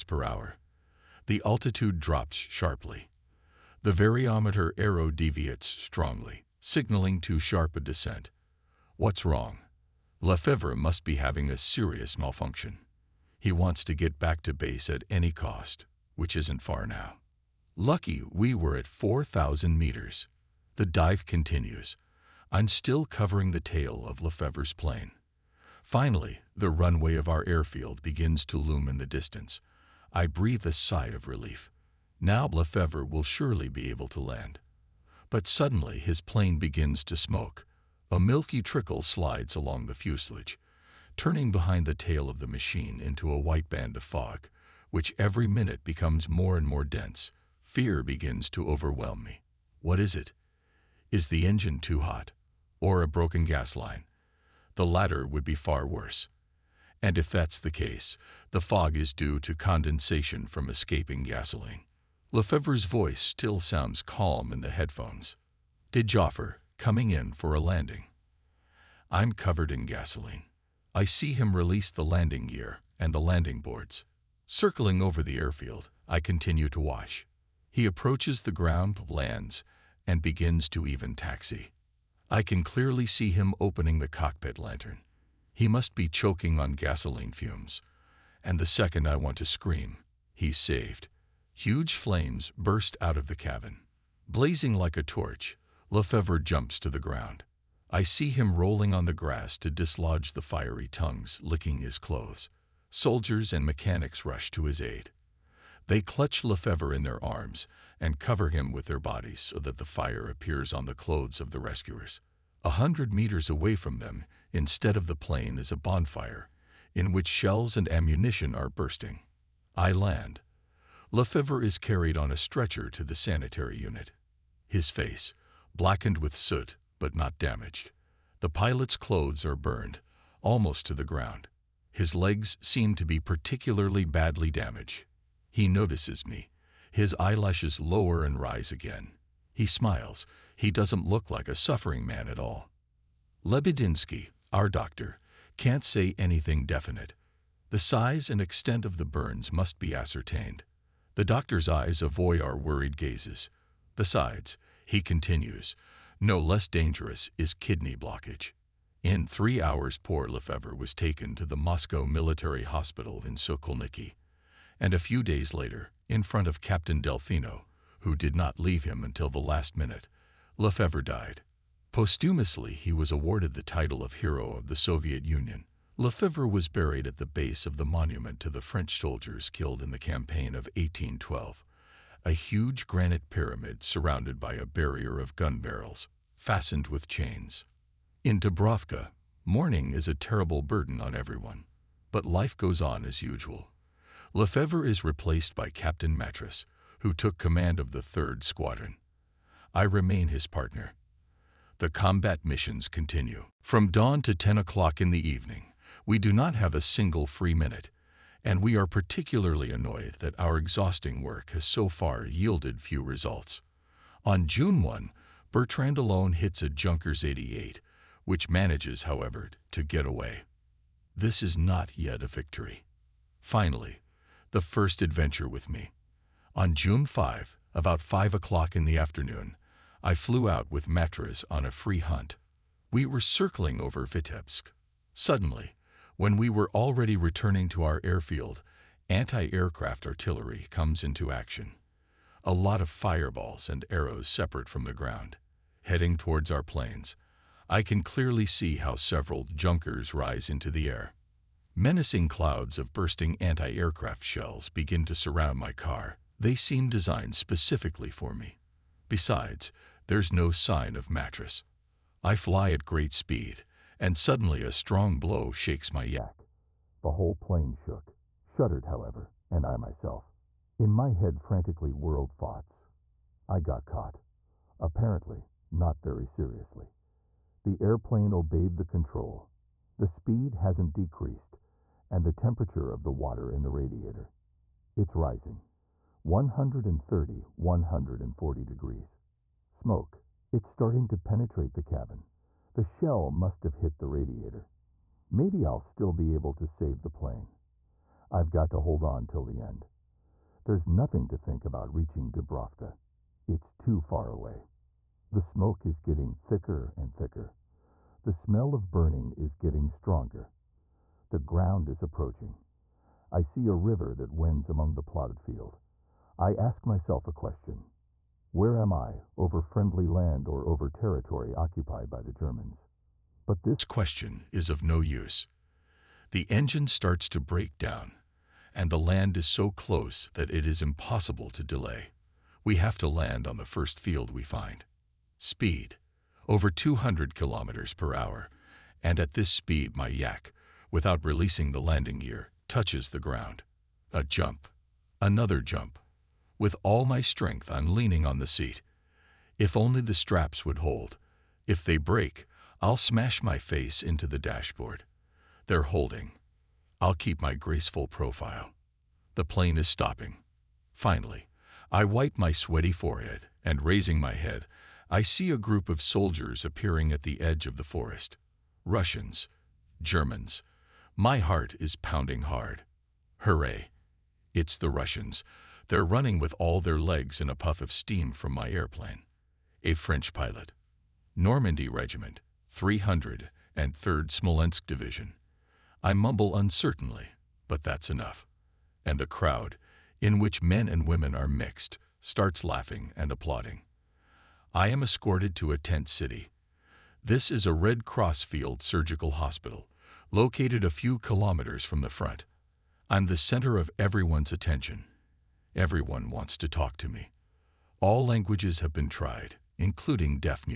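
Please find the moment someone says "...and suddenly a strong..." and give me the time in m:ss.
4:23.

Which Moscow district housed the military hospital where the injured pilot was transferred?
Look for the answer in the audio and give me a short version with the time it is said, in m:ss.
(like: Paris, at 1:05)
Sokolniki, at 2:43.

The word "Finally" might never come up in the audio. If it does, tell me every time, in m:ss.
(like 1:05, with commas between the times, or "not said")
0:25, 3:43, 6:00.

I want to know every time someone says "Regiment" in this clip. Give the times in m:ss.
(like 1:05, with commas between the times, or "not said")
6:21.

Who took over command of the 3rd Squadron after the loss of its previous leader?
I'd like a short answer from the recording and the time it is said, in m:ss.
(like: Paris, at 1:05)
Captain Matras, at 3:15.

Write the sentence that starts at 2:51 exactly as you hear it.
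Posthumously, he was awarded the title of Hero of the Soviet Union.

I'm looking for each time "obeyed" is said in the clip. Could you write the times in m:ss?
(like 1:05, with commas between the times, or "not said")
4:38.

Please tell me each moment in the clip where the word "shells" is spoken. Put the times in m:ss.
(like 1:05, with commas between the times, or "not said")
1:57, 4:14, 4:52.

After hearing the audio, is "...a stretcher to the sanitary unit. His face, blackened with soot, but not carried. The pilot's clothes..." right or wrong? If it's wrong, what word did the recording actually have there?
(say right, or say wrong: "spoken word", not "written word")
wrong: "damaged", not "carried".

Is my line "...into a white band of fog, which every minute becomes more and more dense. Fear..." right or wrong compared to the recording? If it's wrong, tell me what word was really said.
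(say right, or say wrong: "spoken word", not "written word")
right.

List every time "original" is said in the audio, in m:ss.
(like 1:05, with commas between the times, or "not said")
not said.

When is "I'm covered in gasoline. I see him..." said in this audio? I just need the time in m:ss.
1:09.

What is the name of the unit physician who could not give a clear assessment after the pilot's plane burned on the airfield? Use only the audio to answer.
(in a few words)
Lebedinsky.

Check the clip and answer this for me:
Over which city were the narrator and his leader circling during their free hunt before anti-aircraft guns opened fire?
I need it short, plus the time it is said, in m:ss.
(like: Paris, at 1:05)
Vitebsk, at 3:54.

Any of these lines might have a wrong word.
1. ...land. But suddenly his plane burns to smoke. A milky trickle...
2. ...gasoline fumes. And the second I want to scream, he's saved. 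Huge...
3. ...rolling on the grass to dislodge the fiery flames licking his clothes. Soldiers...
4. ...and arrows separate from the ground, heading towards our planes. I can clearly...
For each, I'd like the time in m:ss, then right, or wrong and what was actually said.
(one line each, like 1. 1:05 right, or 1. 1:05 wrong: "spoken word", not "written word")
1. 0:34 wrong: "begins", not "burns"
2. 1:26 right
3. 1:38 wrong: "tongues", not "flames"
4. 4:03 right.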